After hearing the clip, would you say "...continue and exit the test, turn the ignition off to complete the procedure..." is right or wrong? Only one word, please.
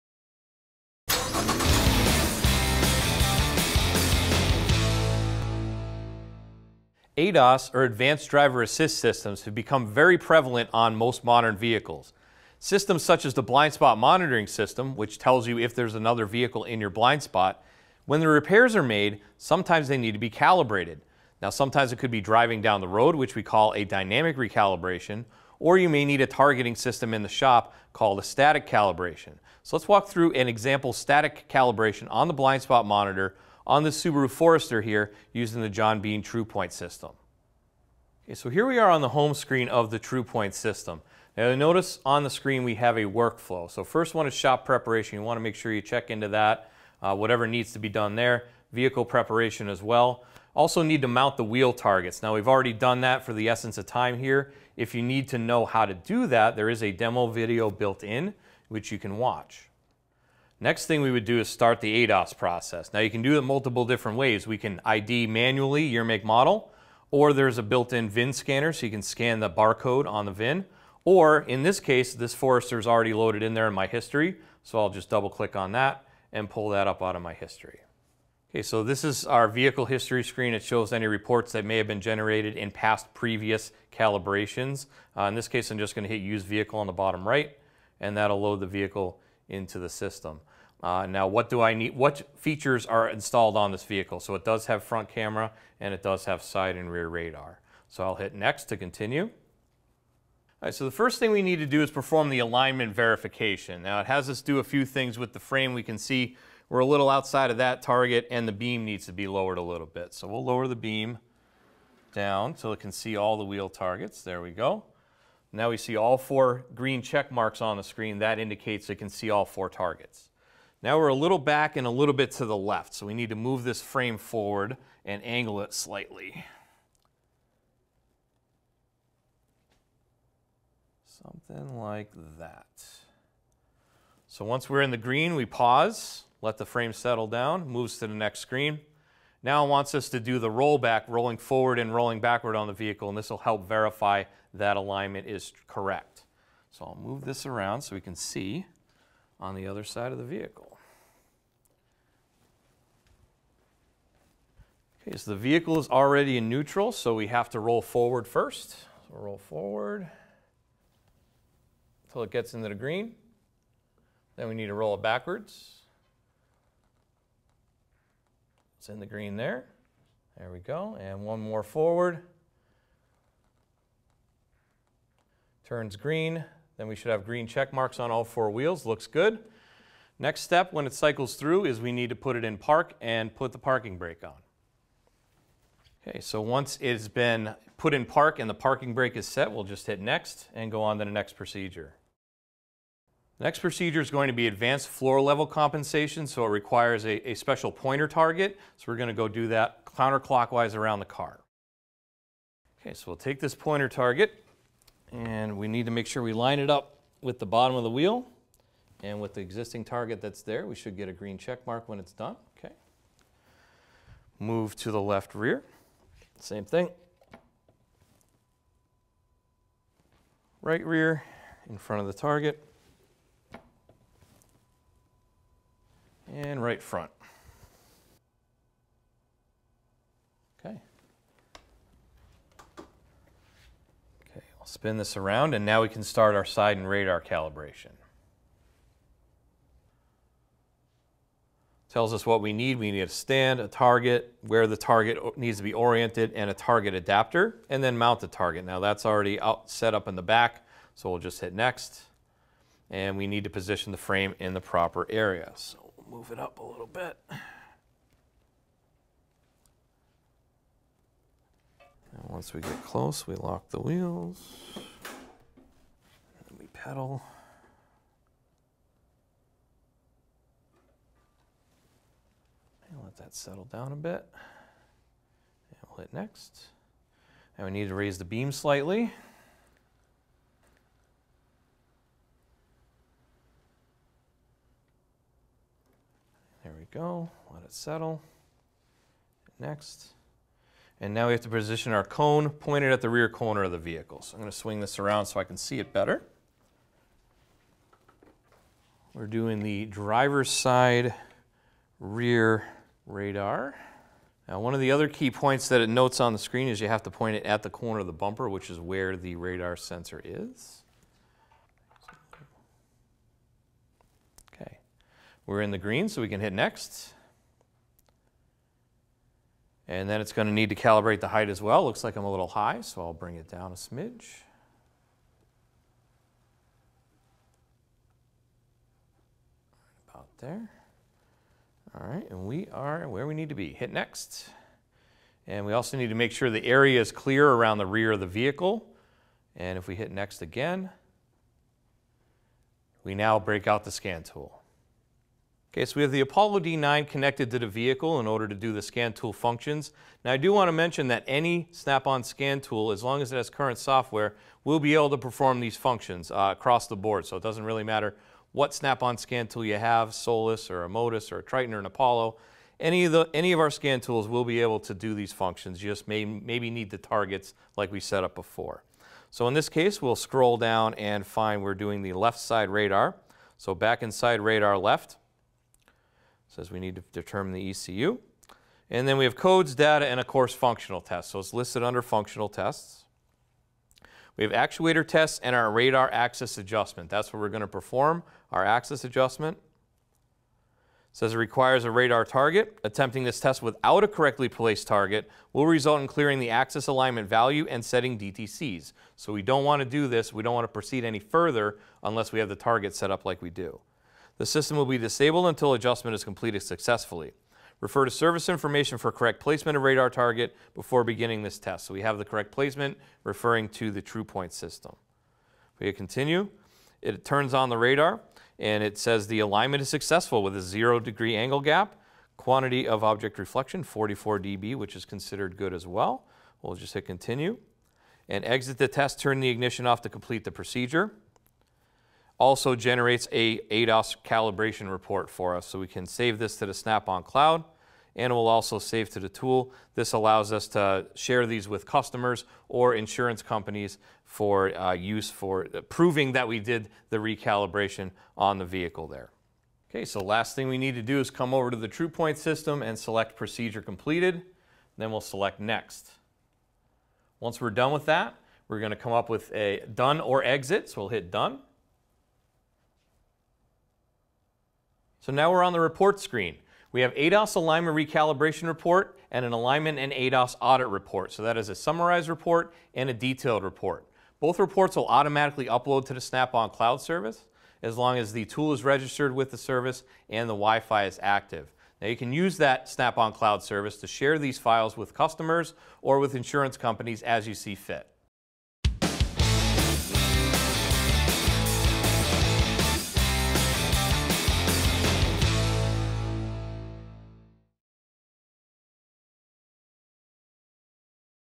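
right.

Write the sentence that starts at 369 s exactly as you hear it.
So in this case, we'll scroll down and find we're doing the left side radar.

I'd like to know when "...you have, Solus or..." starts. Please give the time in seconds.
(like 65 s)
359 s.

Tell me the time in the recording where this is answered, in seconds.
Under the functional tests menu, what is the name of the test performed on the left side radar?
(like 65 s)
385 s.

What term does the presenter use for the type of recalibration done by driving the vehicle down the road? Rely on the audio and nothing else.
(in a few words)
dynamic recalibration.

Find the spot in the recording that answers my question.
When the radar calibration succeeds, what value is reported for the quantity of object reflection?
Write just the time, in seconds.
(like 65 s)
423 s.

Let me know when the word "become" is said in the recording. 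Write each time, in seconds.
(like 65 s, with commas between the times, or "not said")
9 s.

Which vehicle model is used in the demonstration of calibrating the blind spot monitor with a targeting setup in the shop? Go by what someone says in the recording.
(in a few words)
Subaru Forester.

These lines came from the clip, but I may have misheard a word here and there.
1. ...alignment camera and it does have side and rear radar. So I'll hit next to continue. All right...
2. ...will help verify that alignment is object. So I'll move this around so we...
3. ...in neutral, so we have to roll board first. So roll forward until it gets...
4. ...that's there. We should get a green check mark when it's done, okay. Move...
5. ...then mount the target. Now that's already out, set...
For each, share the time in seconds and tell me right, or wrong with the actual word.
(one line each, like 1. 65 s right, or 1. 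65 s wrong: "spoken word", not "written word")
1. 94 s wrong: "front", not "alignment"
2. 143 s wrong: "correct", not "object"
3. 156 s wrong: "forward", not "board"
4. 210 s right
5. 247 s right.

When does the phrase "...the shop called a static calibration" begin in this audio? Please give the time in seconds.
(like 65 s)
27 s.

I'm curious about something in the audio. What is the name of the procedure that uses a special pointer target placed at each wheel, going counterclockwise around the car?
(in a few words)
advanced floor level compensation.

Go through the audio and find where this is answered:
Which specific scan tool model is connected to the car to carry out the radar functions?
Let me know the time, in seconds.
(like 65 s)
346 s.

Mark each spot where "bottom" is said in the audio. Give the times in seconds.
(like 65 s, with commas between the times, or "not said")
86 s, 207 s.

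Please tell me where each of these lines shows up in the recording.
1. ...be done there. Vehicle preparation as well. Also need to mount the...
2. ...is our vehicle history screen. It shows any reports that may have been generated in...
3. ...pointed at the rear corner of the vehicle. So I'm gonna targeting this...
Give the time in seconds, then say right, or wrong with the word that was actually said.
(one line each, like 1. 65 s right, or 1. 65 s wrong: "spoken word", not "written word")
1. 47 s right
2. 79 s right
3. 292 s wrong: "swing", not "targeting".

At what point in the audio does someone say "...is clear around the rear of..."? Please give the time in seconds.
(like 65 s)
337 s.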